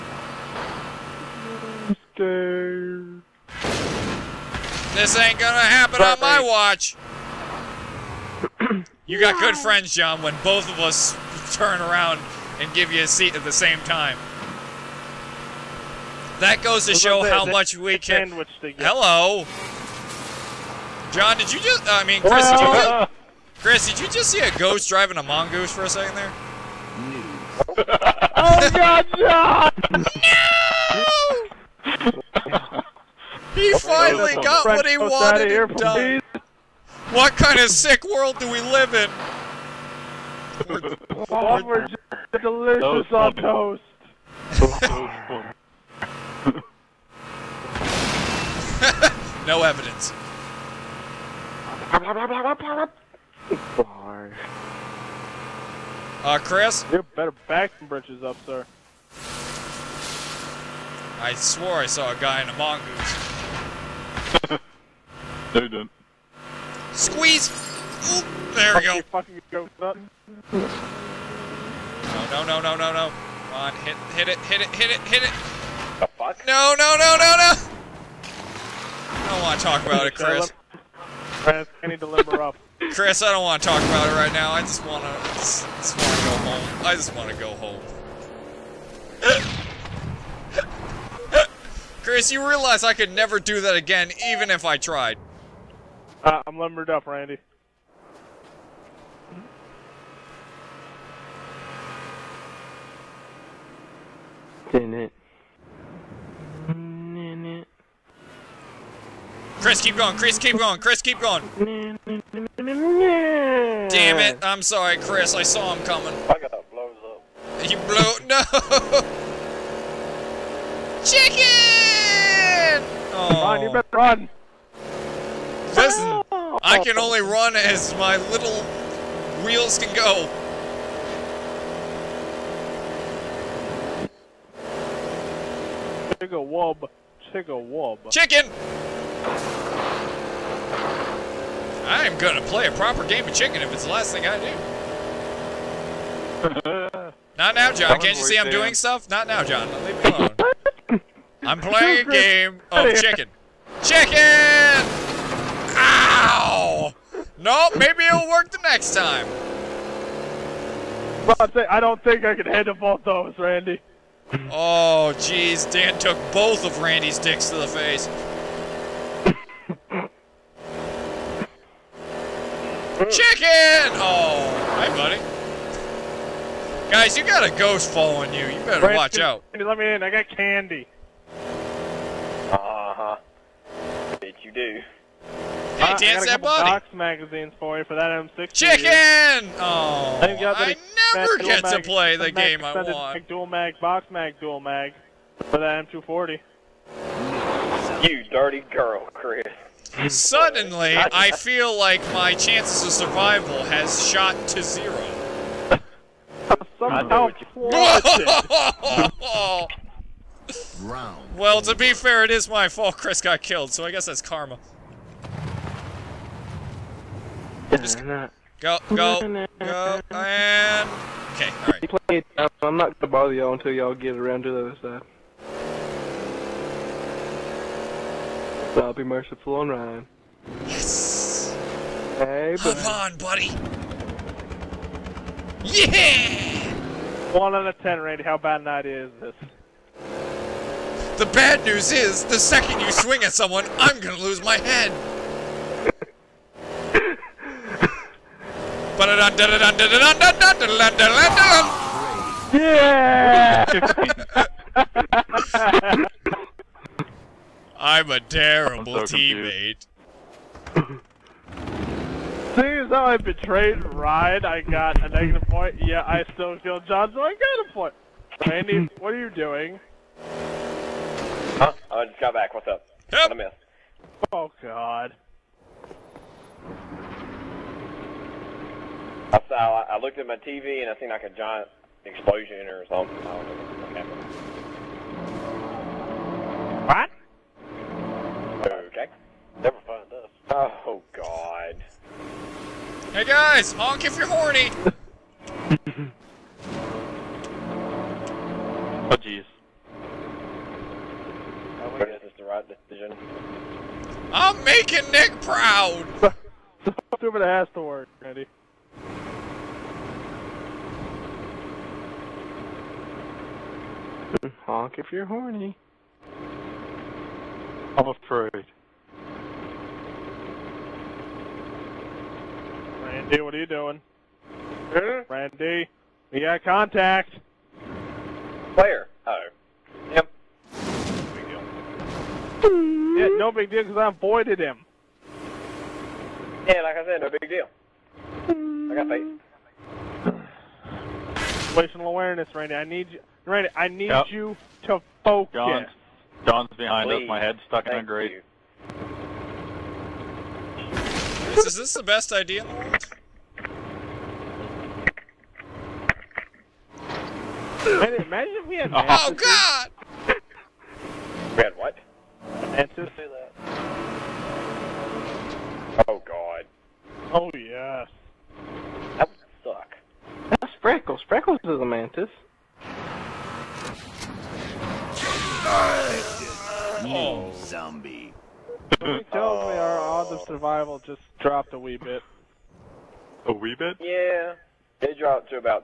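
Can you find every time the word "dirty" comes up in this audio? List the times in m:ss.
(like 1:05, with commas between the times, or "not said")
3:18.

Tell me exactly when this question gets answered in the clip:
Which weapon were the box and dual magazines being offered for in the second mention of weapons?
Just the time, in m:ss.
3:15.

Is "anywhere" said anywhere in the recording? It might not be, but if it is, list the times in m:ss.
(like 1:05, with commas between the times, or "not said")
not said.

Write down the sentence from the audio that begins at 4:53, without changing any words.
Hey guys, honk if you're horny.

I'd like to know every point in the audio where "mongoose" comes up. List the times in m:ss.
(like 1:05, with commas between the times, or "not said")
0:25, 1:02.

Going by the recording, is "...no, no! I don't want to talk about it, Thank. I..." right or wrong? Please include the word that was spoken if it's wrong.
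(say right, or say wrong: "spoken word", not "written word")
wrong: "Chris", not "Thank".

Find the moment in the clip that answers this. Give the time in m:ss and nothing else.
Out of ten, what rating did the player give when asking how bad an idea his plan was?
3:57.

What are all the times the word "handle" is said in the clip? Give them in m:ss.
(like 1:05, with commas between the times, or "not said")
2:42.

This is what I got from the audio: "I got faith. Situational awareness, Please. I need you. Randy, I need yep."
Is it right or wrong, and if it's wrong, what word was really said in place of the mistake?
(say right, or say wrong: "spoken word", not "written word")
wrong: "Randy", not "Please".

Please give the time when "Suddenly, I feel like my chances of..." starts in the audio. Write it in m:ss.
3:20.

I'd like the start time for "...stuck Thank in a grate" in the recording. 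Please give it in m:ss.
5:47.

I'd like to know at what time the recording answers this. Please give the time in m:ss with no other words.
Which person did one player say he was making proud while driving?
5:05.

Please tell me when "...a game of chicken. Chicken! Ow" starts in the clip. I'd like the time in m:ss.
2:32.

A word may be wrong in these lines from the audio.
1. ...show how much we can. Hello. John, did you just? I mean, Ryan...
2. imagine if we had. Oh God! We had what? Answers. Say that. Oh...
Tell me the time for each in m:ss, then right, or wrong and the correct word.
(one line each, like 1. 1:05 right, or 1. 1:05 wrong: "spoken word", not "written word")
1. 0:16 wrong: "Chris", not "Ryan"
2. 5:57 right.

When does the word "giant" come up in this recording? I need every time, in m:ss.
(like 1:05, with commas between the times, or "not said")
4:41.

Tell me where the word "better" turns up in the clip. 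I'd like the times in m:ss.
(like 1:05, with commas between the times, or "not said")
0:57, 2:03, 2:58.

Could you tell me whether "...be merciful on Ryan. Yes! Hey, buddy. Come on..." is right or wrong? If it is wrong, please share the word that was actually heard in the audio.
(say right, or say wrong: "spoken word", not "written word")
right.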